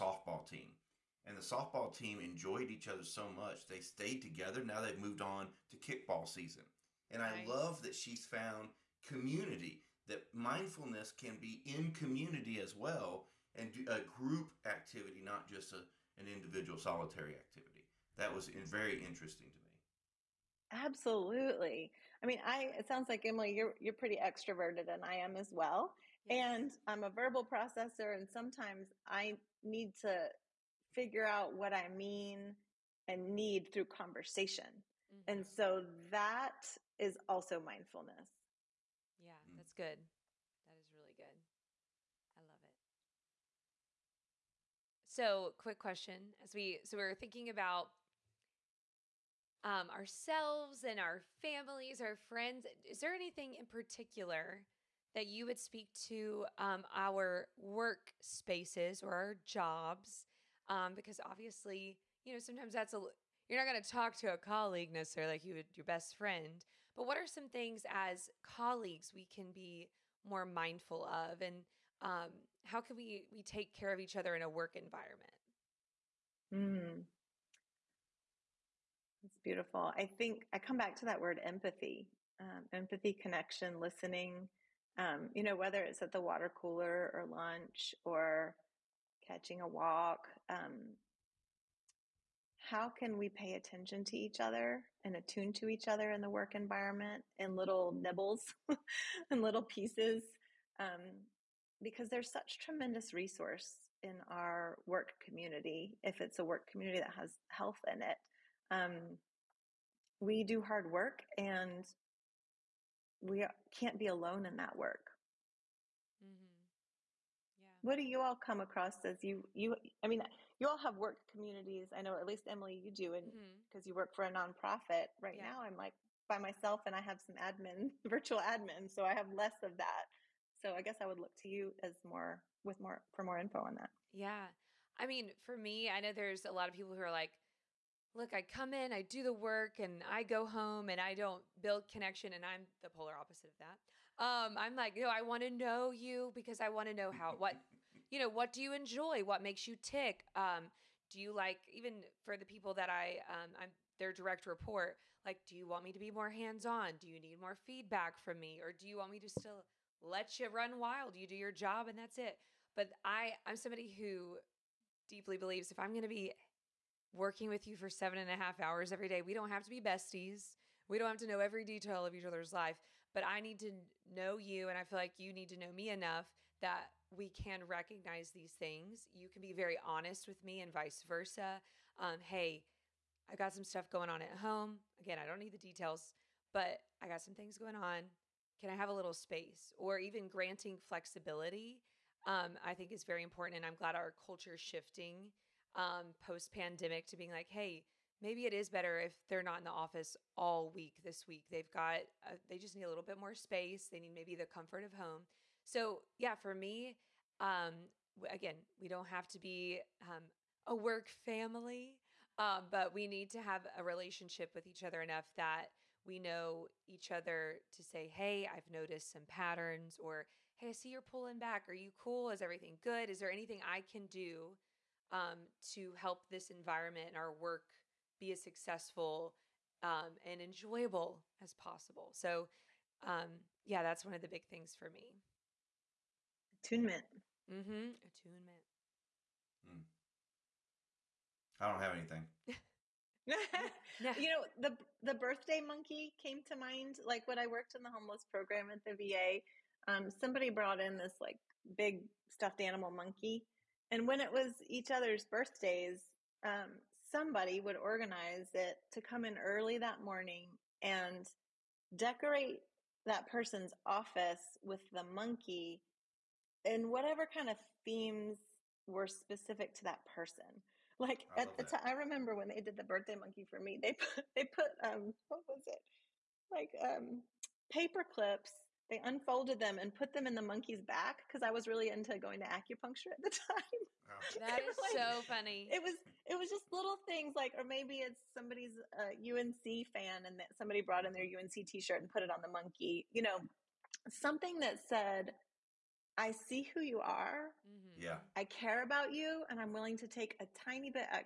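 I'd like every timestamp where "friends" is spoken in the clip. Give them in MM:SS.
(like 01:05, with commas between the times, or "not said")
00:52, 01:06.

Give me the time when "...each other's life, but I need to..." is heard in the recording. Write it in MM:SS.
02:52.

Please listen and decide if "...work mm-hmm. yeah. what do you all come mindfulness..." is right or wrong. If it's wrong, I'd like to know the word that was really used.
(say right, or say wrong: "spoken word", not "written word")
wrong: "across", not "mindfulness".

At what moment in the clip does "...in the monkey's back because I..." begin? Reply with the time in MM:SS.
04:40.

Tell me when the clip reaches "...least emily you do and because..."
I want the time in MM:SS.
02:02.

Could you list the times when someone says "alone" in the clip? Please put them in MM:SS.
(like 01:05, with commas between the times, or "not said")
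01:54.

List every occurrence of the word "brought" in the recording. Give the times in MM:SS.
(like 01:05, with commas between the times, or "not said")
04:10, 04:50.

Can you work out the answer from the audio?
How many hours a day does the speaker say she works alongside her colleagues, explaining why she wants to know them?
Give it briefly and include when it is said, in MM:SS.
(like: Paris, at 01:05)
7.5, at 02:47.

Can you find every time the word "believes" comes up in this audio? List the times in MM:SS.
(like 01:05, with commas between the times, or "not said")
02:45.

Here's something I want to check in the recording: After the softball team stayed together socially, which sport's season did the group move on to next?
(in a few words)
Kickball.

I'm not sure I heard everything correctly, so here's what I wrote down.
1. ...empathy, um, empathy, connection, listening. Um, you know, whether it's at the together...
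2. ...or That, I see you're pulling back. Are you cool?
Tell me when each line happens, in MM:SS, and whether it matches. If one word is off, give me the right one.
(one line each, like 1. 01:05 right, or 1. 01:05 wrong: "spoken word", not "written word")
1. 01:21 wrong: "water", not "together"
2. 03:39 wrong: "Hey", not "That".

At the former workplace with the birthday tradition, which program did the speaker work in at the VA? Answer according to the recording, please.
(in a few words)
Homeless program.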